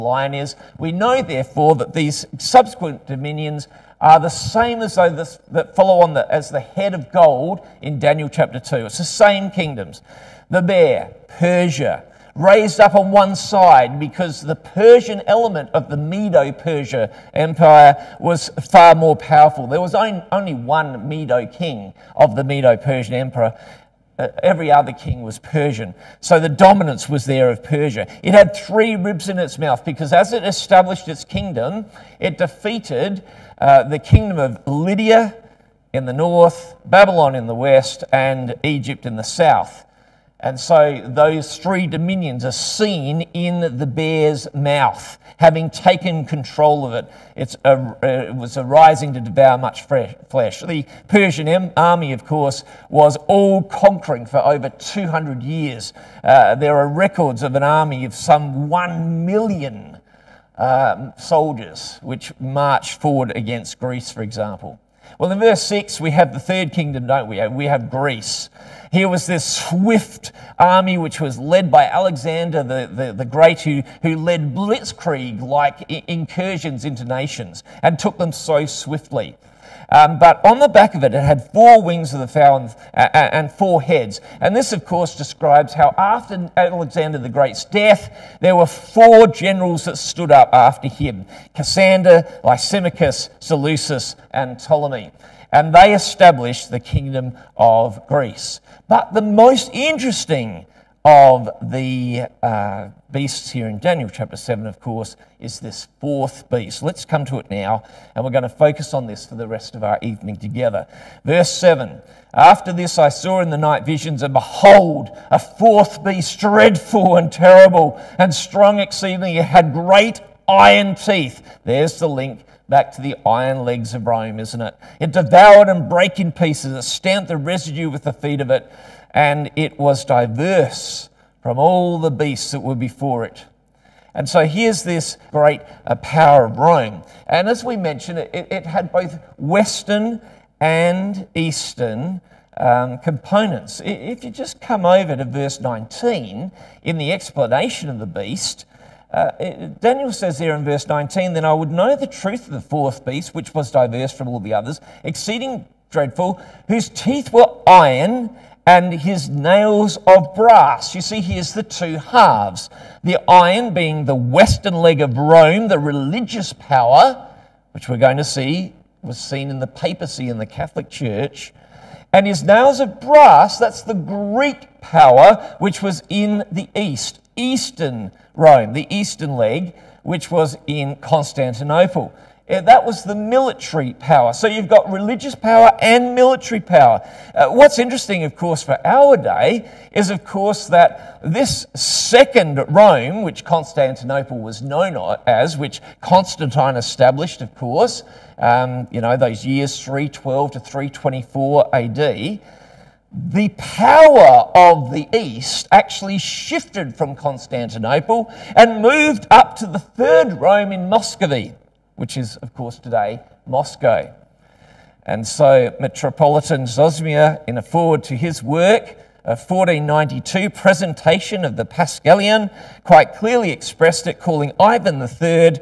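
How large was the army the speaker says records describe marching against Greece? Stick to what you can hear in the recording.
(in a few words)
1 million.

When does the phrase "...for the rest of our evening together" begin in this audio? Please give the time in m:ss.
1:49.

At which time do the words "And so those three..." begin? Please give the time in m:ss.
0:40.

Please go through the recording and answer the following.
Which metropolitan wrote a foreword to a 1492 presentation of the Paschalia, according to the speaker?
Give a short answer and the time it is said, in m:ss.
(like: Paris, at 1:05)
Zosima, at 3:36.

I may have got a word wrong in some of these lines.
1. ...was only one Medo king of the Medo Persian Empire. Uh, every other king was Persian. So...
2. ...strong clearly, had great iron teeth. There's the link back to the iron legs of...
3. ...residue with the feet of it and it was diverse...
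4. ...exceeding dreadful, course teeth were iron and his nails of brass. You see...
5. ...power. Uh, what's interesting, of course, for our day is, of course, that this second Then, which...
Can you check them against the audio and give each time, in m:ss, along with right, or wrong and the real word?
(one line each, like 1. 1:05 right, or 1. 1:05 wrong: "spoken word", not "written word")
1. 0:19 right
2. 1:58 wrong: "exceedingly", not "clearly"
3. 2:07 right
4. 2:35 wrong: "whose", not "course"
5. 3:06 wrong: "Rome", not "Then".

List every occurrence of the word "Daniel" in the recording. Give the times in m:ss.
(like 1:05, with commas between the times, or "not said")
0:07, 1:43, 2:29.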